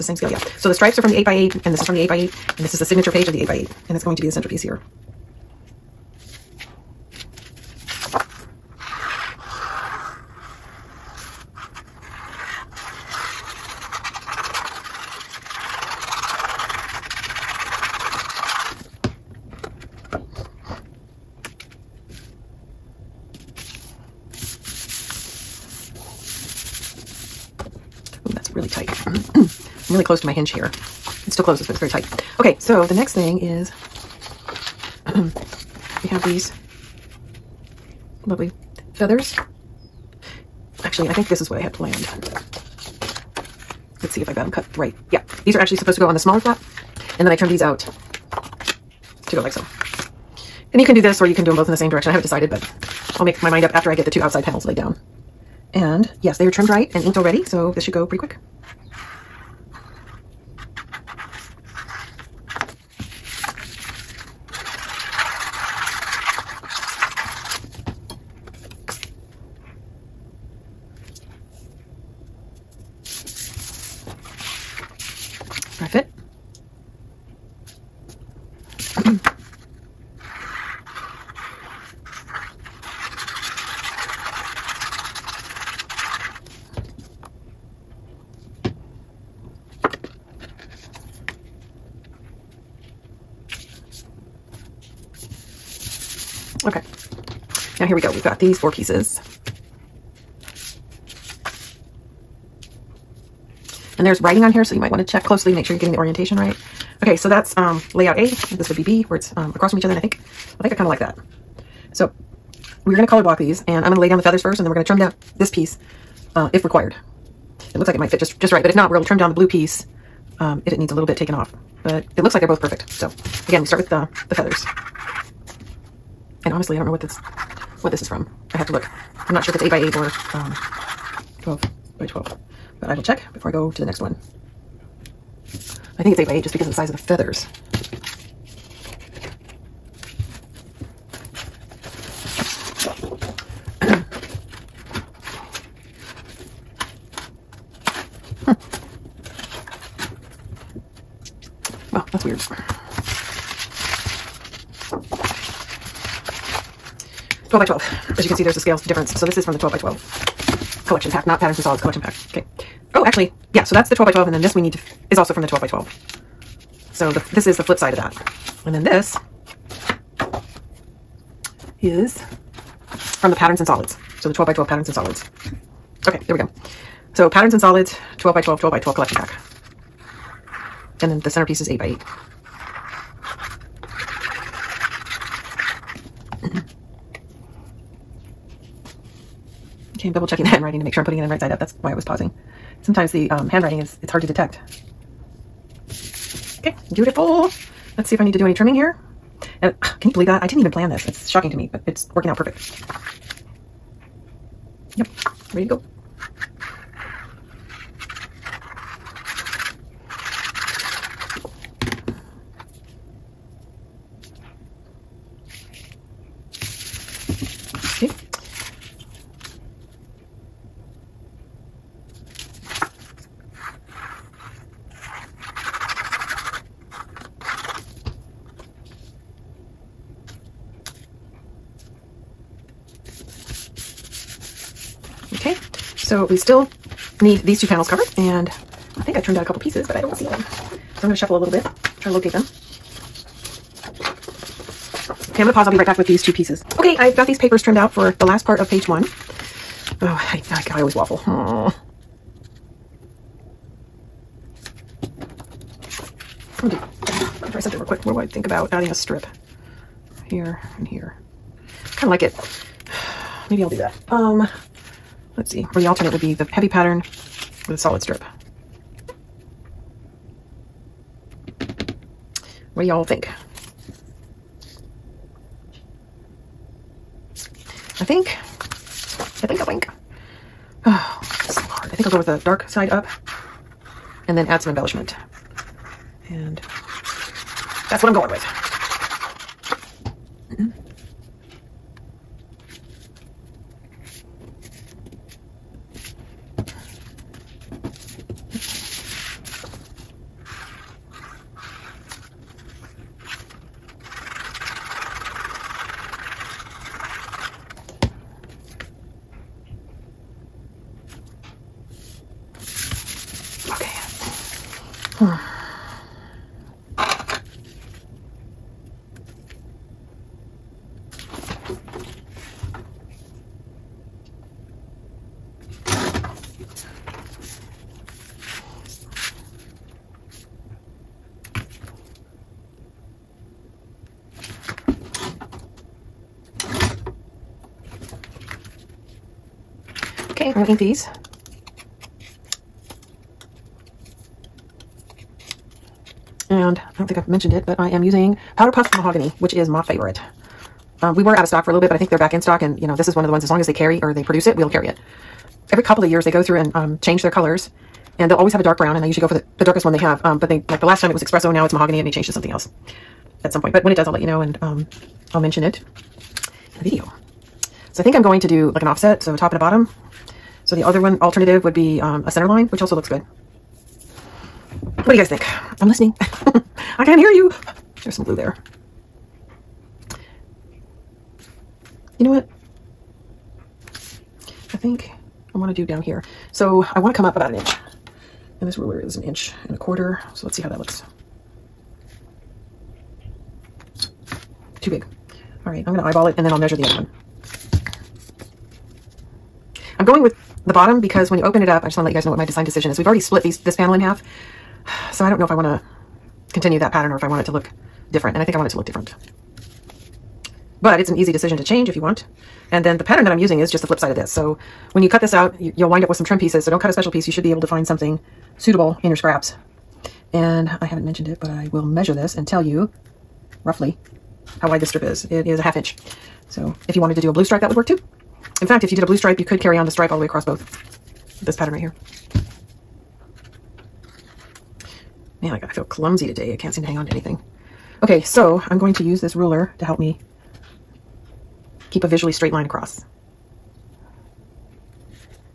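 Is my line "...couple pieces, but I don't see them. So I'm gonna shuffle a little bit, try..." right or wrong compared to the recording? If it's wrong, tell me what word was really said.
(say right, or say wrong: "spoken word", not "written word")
right.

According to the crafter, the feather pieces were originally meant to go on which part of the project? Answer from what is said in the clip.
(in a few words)
smaller flap.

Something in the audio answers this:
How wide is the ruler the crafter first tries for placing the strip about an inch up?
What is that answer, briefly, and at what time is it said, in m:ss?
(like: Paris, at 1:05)
1 1/4 inches, at 6:29.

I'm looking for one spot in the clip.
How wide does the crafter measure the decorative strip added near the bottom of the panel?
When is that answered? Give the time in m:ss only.
7:05.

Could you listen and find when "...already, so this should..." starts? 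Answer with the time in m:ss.
0:57.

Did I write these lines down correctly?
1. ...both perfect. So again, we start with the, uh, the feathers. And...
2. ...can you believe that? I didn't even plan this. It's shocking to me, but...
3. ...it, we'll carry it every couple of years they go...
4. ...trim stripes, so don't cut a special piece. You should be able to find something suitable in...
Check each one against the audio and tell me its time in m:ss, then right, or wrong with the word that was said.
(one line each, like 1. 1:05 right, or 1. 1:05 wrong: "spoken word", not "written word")
1. 2:02 right
2. 3:20 right
3. 5:54 right
4. 6:56 wrong: "pieces", not "stripes".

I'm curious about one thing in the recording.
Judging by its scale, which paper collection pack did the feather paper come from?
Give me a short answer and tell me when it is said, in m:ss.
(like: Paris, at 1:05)
12 by 12 collection pack, at 2:39.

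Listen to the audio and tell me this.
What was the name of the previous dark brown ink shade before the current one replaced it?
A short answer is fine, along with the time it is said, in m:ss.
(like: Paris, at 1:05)
espresso, at 6:01.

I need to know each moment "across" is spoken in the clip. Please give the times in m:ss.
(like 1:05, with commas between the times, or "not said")
1:49, 7:10, 7:22.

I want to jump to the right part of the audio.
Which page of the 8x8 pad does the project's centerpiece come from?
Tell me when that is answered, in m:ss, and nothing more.
0:02.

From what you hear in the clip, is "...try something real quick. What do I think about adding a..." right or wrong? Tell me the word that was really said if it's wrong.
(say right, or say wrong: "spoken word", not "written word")
right.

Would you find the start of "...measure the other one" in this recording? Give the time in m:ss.
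6:36.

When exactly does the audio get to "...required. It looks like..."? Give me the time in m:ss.
1:56.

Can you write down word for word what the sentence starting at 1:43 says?
And there's writing on here, so you might want to check closely to make sure you're getting the orientation right.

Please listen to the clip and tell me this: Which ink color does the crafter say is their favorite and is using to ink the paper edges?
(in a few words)
Powder Puff Mahogany.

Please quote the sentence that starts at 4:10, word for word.
Oh, I, I, I always waffle.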